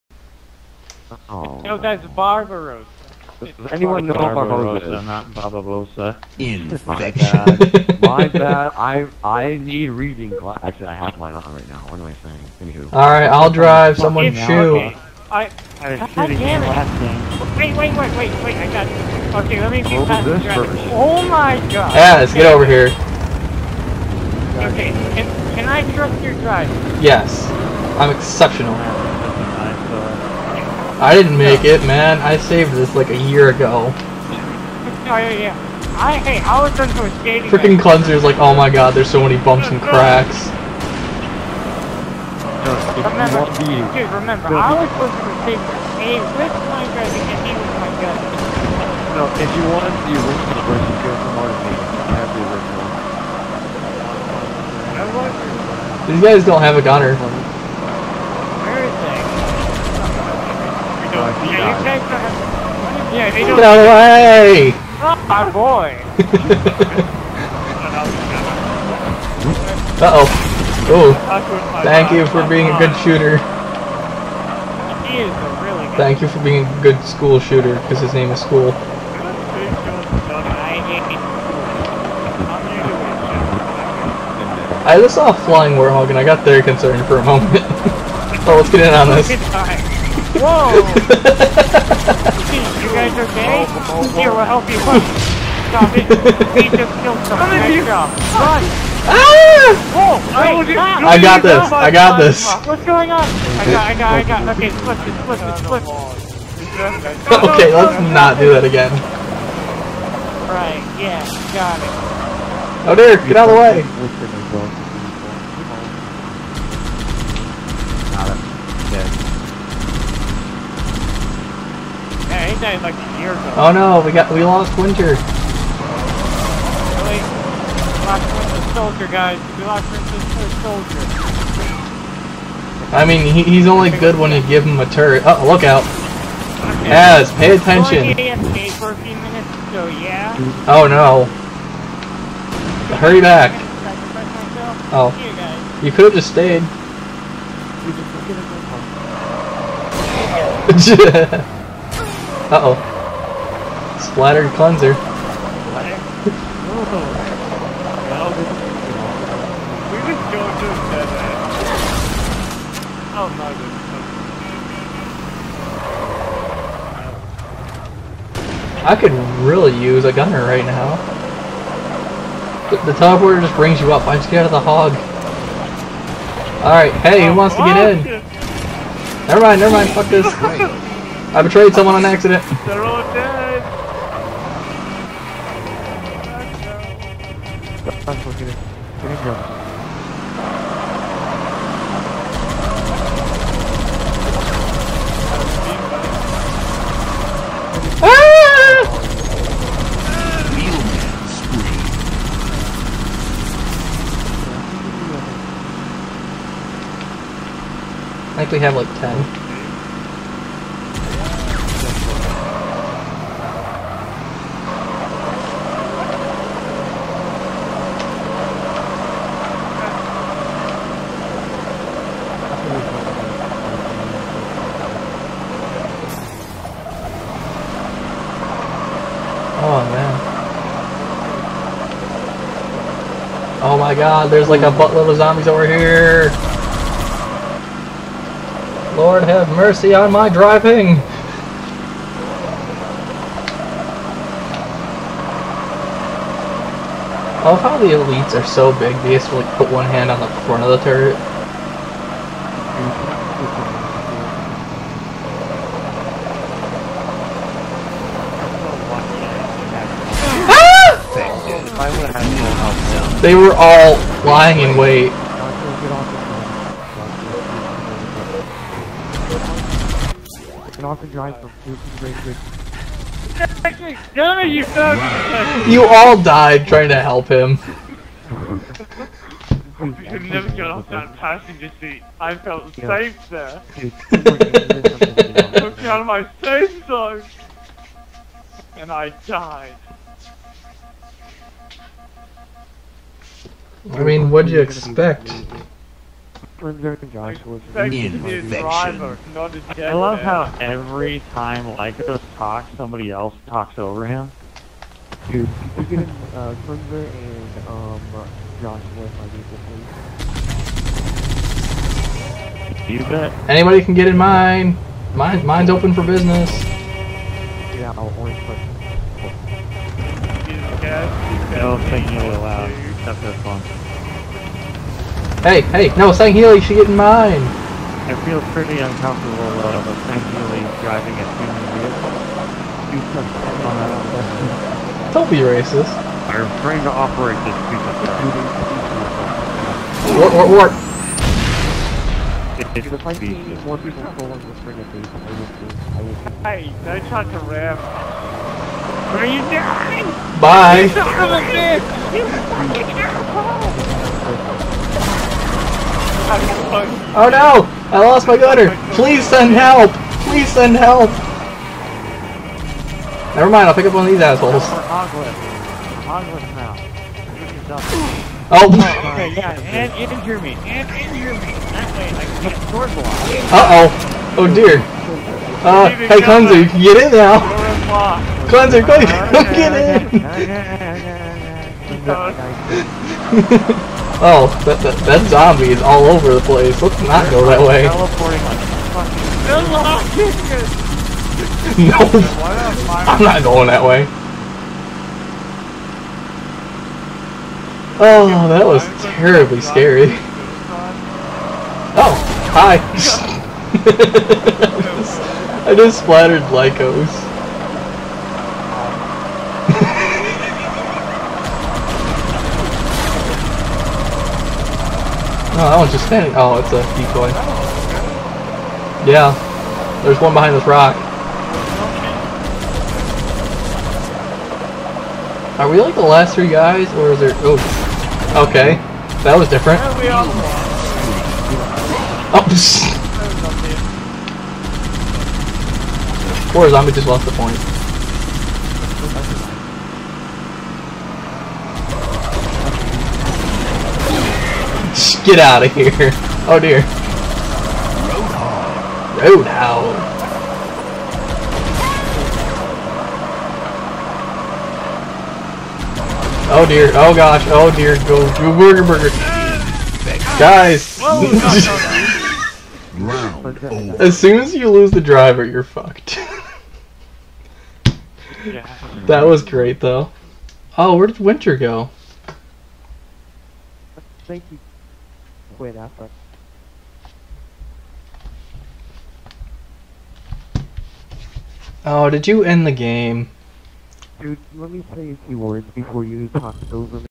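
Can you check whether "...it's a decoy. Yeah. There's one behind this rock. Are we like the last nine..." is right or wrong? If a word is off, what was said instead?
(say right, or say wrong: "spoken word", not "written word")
wrong: "three", not "nine".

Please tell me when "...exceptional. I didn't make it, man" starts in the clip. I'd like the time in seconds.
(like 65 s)
28 s.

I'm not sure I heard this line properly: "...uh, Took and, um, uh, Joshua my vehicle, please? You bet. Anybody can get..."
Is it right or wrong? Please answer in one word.
wrong.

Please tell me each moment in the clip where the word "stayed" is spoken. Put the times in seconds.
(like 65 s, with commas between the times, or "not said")
146 s.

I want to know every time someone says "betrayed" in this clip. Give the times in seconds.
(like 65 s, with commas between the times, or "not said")
181 s.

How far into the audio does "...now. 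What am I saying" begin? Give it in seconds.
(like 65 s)
11 s.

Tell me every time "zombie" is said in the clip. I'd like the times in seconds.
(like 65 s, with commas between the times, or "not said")
235 s, 385 s, 436 s.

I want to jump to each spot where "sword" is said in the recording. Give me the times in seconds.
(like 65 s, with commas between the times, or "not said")
372 s.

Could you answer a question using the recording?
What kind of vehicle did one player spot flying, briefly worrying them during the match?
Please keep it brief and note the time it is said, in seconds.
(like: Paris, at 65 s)
warthog, at 85 s.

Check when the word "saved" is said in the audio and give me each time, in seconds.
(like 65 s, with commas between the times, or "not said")
32 s.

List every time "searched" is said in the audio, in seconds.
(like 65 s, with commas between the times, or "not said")
not said.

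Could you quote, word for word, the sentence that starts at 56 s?
These guys don't have a gunner.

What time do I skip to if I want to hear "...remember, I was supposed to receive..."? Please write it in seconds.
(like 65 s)
44 s.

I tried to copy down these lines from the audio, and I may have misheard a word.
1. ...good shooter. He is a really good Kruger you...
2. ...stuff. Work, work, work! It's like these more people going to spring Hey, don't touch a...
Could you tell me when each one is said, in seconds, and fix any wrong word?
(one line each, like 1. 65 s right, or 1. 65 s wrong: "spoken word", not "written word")
1. 72 s wrong: "Thank", not "Kruger"
2. 338 s right.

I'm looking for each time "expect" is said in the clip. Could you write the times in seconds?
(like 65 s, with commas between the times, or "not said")
294 s.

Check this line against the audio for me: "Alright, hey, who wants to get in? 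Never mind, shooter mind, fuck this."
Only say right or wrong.
wrong.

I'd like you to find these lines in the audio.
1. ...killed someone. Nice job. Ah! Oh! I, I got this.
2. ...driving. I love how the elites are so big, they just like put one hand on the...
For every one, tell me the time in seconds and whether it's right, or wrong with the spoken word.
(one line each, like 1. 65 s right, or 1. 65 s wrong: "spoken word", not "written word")
1. 97 s right
2. 240 s right.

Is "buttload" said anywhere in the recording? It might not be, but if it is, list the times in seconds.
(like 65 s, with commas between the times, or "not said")
234 s.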